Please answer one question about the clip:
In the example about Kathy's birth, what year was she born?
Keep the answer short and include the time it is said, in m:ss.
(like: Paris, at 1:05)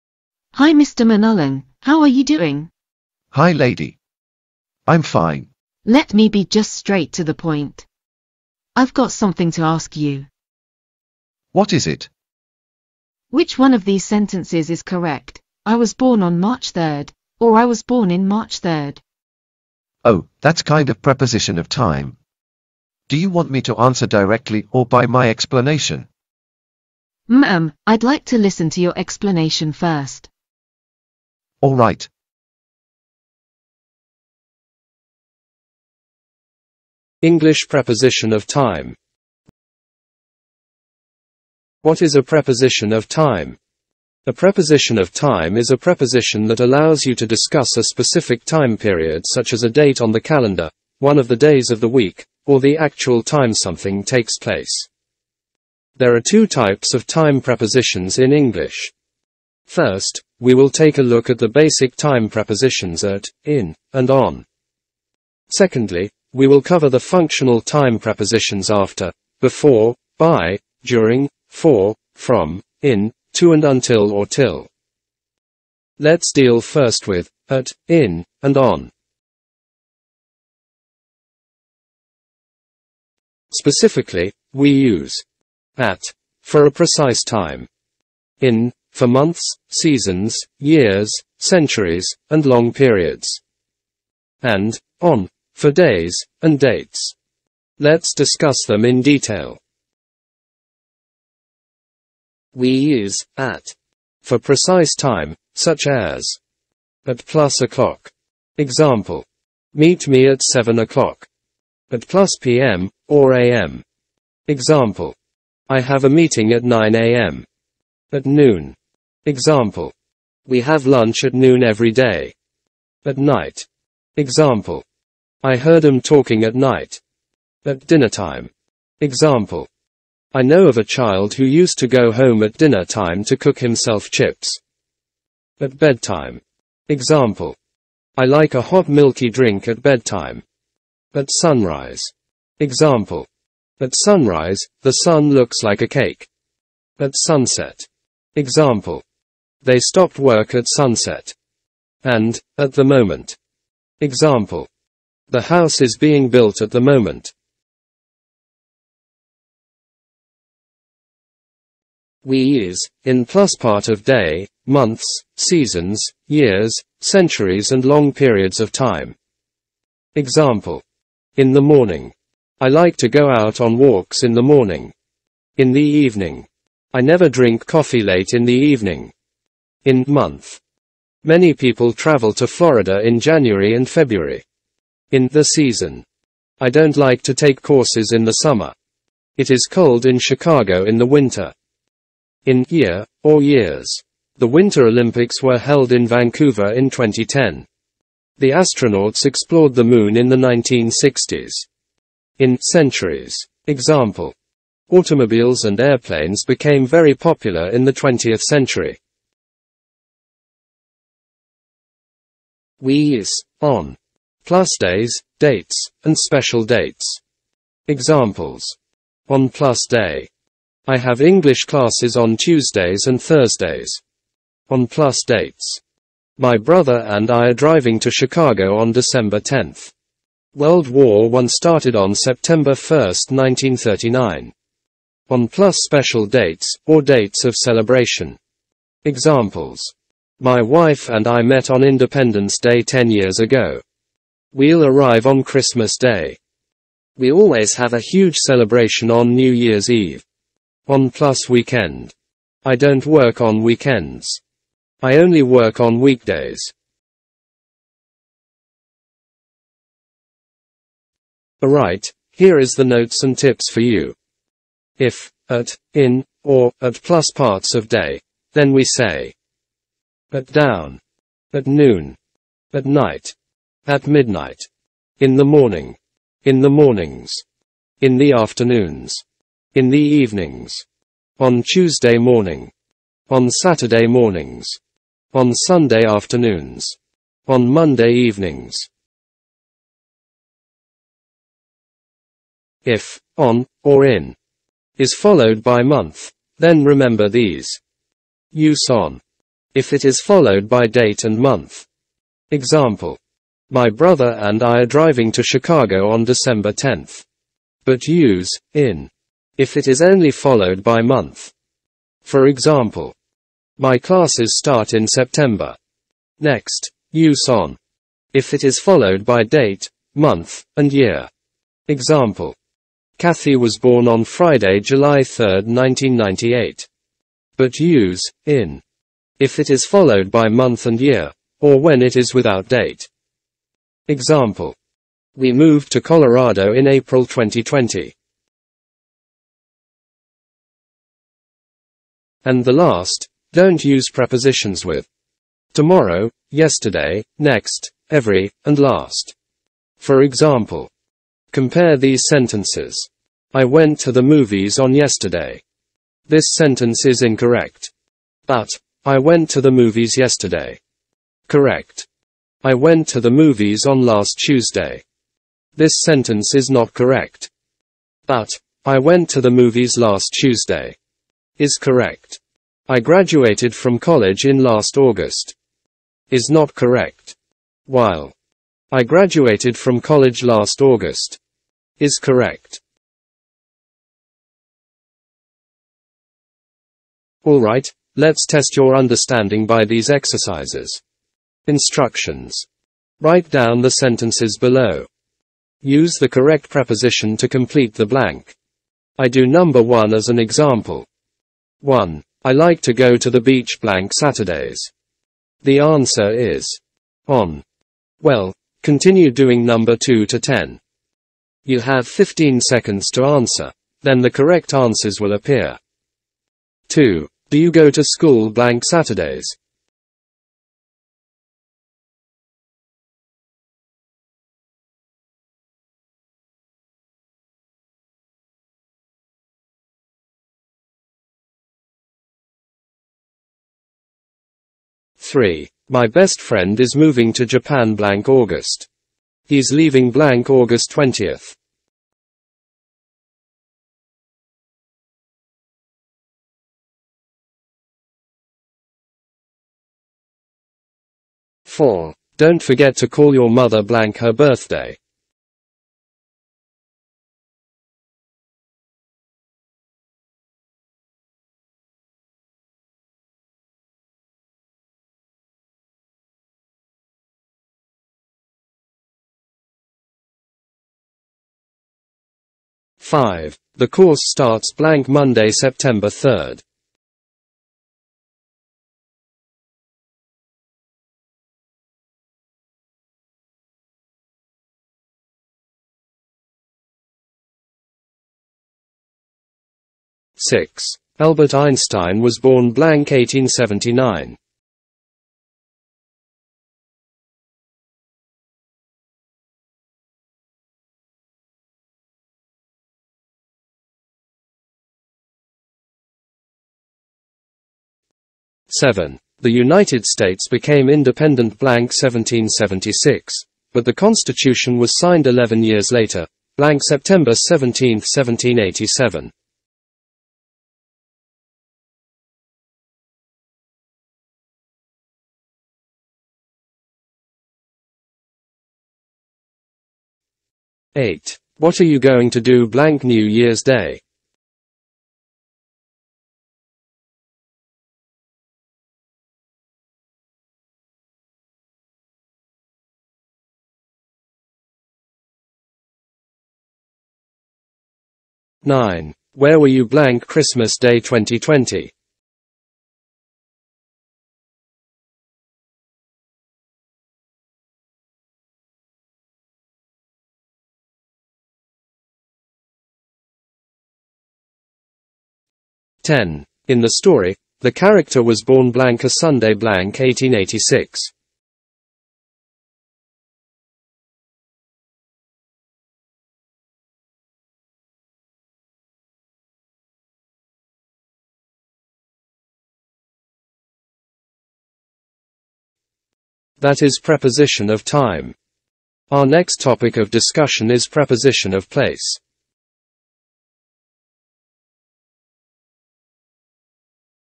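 1998, at 5:25.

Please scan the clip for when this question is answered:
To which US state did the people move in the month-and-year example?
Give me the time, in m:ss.
5:36.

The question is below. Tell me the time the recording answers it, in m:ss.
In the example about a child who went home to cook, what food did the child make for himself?
2:14.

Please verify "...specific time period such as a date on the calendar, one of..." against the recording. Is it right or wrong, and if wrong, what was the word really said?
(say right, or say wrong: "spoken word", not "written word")
right.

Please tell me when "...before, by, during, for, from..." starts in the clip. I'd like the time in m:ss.
1:09.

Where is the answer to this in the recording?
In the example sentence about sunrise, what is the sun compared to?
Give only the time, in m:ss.
2:25.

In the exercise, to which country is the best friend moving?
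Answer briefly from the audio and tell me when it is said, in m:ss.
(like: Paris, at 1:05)
Japan, at 7:17.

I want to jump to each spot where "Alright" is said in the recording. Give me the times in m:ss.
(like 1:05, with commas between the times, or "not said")
4:21, 6:27.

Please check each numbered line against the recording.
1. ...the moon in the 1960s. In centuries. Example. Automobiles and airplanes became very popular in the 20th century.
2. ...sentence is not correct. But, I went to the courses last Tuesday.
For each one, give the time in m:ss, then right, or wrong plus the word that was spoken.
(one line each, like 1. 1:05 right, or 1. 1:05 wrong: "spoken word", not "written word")
1. 3:19 right
2. 6:06 wrong: "movies", not "courses".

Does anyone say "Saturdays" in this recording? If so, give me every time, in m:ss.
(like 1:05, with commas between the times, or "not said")
4:43, 6:44, 6:58.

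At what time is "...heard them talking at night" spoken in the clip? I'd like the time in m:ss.
2:05.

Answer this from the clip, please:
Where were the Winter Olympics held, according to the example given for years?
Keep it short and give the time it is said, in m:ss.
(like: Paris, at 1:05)
Vancouver, at 3:16.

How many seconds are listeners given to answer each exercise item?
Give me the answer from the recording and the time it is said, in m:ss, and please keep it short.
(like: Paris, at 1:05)
15, at 6:52.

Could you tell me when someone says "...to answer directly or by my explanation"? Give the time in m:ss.
0:23.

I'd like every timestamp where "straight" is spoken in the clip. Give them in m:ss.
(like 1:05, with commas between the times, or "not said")
0:06.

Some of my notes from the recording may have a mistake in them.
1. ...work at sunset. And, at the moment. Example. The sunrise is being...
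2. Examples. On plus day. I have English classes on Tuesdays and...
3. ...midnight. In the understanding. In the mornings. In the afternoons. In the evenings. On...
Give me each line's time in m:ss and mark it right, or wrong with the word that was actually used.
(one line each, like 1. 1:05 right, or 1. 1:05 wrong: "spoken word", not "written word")
1. 2:30 wrong: "house", not "sunrise"
2. 3:37 right
3. 4:34 wrong: "morning", not "understanding".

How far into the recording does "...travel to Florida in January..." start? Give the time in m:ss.
3:01.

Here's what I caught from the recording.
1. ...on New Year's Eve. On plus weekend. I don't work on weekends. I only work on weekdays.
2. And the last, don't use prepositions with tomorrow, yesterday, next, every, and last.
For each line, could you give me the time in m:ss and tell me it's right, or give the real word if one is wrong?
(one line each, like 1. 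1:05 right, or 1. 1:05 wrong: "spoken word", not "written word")
1. 4:09 right
2. 5:42 right.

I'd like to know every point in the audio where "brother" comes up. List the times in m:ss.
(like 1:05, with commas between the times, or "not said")
3:46, 5:03.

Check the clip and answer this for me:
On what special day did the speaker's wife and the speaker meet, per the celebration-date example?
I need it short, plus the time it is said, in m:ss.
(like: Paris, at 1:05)
Independence Day, at 4:01.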